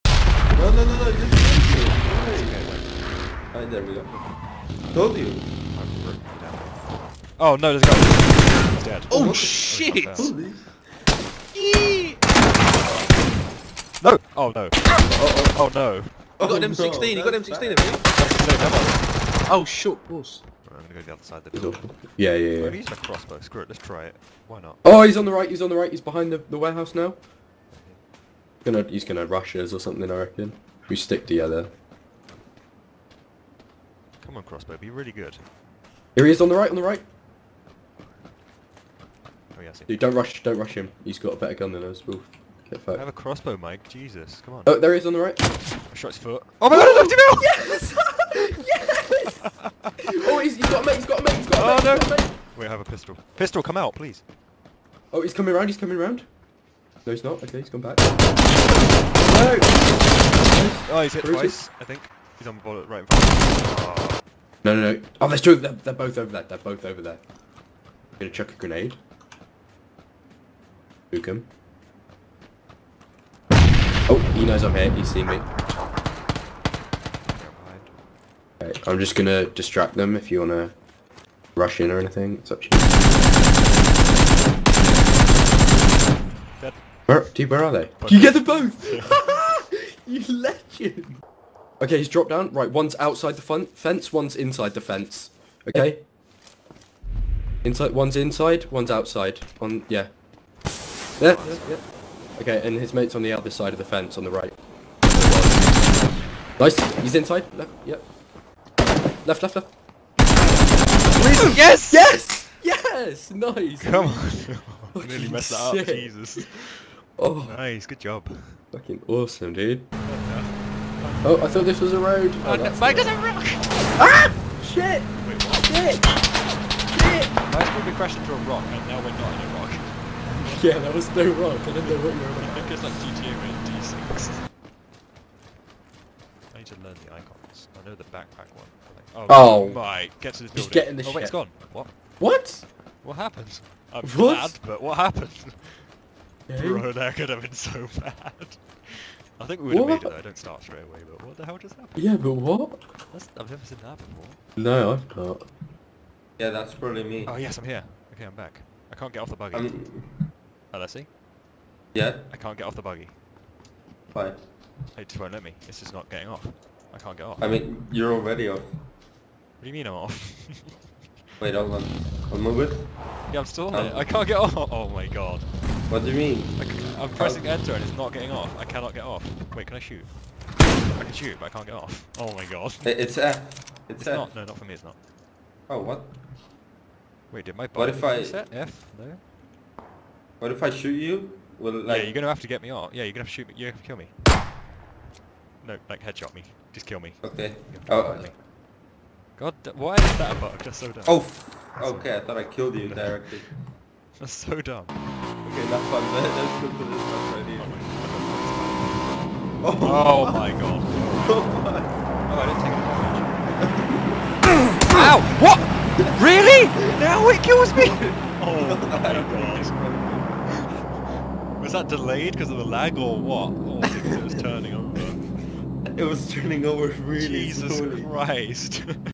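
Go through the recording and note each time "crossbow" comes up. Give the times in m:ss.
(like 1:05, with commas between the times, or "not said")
0:22, 0:34, 0:43.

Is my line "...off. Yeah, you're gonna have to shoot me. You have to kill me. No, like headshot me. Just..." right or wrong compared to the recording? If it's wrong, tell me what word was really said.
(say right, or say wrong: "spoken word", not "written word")
right.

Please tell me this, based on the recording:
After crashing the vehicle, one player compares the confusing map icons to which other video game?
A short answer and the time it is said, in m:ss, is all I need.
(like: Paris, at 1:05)
GTA, at 2:12.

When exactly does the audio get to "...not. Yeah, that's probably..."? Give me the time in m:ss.
2:35.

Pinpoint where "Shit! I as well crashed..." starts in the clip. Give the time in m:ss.
2:06.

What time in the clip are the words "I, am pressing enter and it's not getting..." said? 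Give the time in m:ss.
2:56.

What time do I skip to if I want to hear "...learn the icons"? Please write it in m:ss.
2:16.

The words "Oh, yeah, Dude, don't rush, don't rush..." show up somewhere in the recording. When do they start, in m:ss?
0:39.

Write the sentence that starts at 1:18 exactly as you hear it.
I'm just gonna distract them if you wanna rush in or anything.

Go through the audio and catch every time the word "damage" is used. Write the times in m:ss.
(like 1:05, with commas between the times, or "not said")
3:34.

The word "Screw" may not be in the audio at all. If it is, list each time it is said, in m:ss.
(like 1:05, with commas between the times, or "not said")
0:23.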